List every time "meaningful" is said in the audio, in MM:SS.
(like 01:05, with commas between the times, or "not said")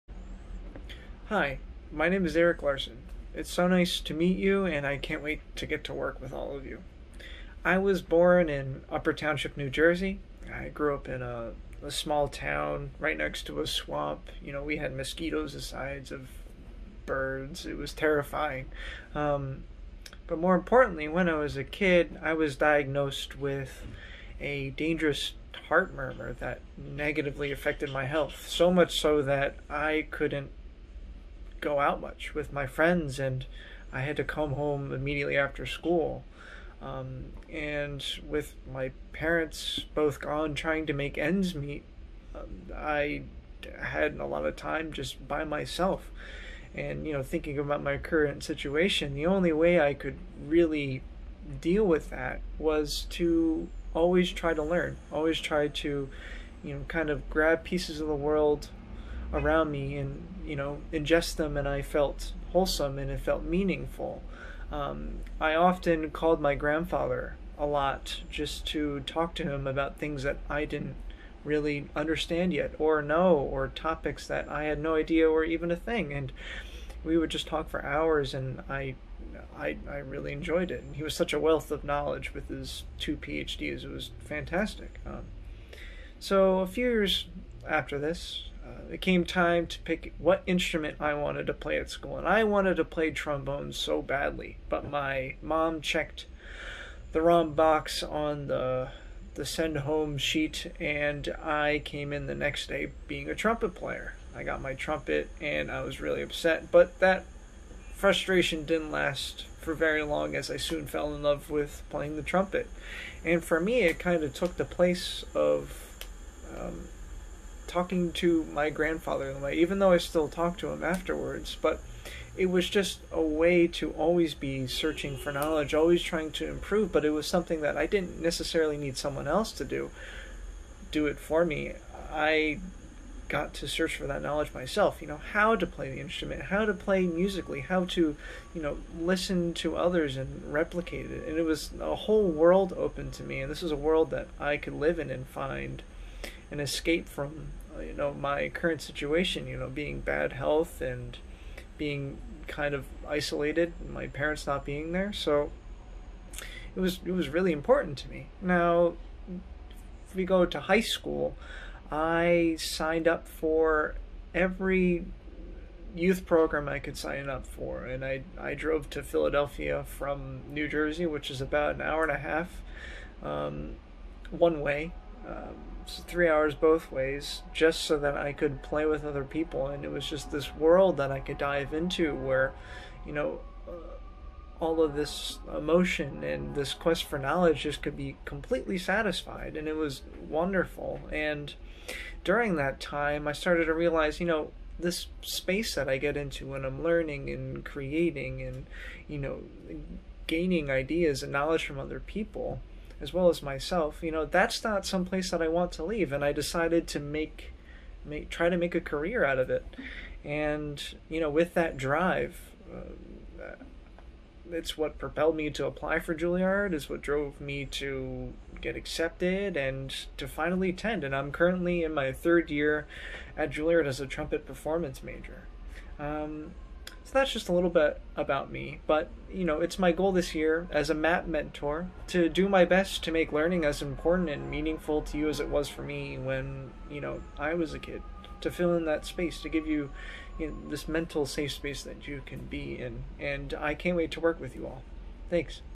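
01:03, 03:54.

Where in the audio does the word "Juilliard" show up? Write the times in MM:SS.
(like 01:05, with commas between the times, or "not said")
03:36, 03:43.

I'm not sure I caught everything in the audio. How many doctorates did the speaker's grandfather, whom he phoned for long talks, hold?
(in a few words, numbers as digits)
2.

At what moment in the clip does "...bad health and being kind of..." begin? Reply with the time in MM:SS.
02:30.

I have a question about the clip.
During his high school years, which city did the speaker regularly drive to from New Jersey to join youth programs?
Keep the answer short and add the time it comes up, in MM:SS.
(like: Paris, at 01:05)
Philadelphia, at 02:49.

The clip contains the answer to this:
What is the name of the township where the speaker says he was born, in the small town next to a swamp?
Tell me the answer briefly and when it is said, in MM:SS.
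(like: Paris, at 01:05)
Upper Township, at 00:08.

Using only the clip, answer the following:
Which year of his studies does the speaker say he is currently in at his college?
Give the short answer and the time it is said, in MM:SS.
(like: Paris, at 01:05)
Third year, at 03:42.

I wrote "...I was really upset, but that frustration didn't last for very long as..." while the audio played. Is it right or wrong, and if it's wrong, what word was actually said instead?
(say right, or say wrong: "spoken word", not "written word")
right.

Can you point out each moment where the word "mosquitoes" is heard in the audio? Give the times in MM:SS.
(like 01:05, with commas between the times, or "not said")
00:14.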